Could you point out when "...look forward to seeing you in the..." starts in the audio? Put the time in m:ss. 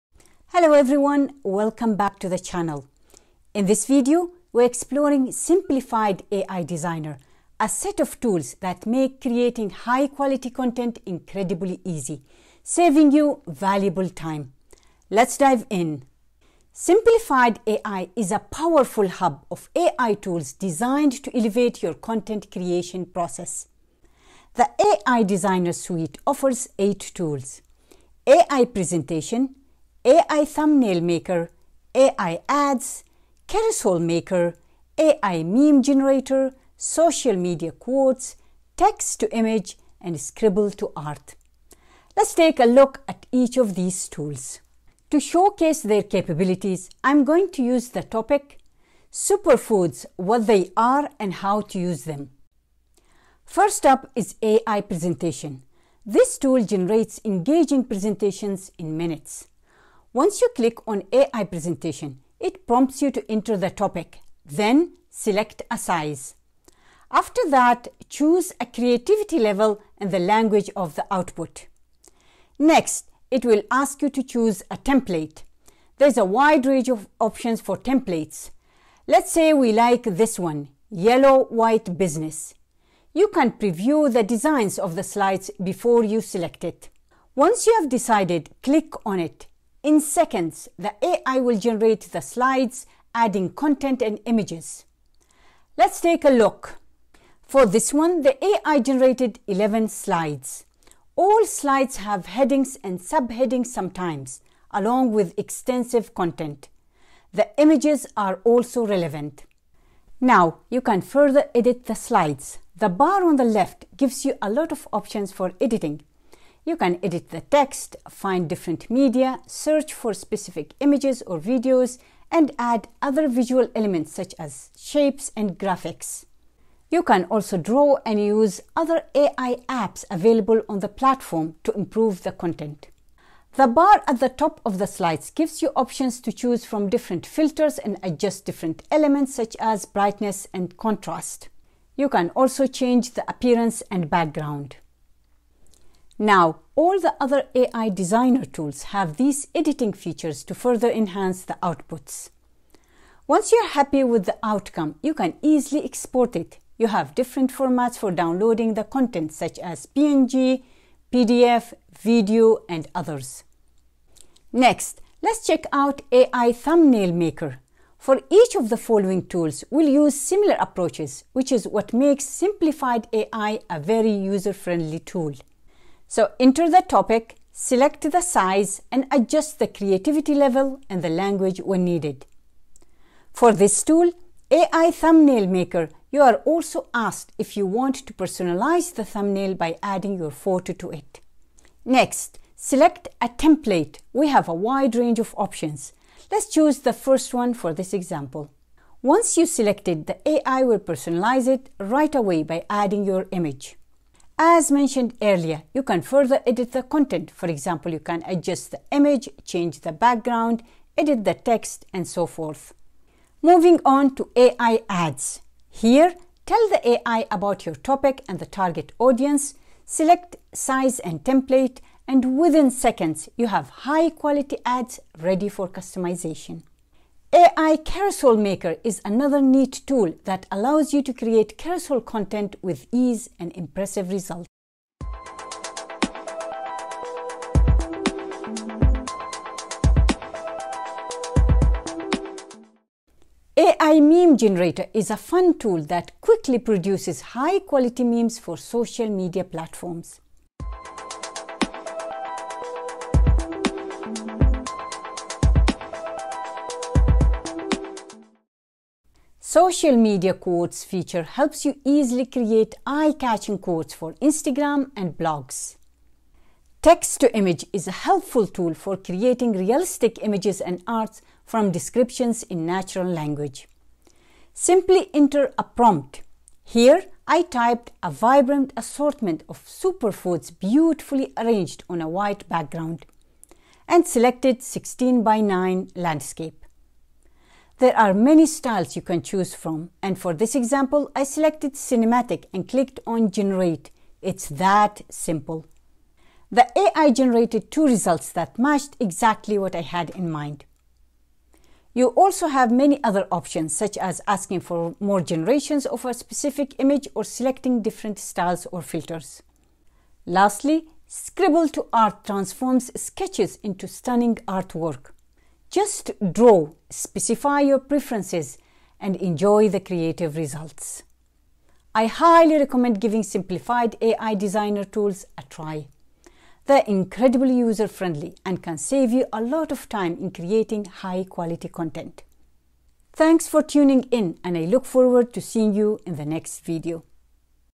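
5:34.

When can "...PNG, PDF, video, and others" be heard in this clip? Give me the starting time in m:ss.
2:39.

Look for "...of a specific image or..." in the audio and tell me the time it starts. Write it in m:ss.
5:05.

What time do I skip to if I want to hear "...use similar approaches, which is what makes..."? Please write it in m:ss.
2:49.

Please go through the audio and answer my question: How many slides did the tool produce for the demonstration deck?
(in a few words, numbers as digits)
11.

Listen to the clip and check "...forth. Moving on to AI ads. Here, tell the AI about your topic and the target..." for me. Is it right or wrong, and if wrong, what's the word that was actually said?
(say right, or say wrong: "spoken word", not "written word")
right.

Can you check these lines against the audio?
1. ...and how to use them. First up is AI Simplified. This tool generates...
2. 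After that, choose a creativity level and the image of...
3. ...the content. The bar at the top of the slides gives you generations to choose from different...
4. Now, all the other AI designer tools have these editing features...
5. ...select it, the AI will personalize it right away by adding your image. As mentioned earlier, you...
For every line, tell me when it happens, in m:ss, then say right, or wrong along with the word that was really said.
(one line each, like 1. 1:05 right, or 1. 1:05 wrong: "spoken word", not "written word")
1. 0:51 wrong: "Presentation", not "Simplified"
2. 1:07 wrong: "language", not "image"
3. 2:12 wrong: "options", not "generations"
4. 2:26 right
5. 3:19 right.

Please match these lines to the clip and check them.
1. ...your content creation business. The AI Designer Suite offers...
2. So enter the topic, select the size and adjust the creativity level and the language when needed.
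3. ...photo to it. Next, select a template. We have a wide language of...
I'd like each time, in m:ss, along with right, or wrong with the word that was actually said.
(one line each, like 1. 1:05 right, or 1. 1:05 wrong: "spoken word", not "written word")
1. 0:21 wrong: "process", not "business"
2. 2:56 right
3. 3:10 wrong: "range", not "language".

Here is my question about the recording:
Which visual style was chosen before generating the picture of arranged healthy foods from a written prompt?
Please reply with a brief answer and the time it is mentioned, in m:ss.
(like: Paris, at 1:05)
Cinematic, at 4:51.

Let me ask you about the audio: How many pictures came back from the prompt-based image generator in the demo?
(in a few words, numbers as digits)
2.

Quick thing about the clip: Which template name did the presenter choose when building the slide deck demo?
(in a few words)
Yellow white business.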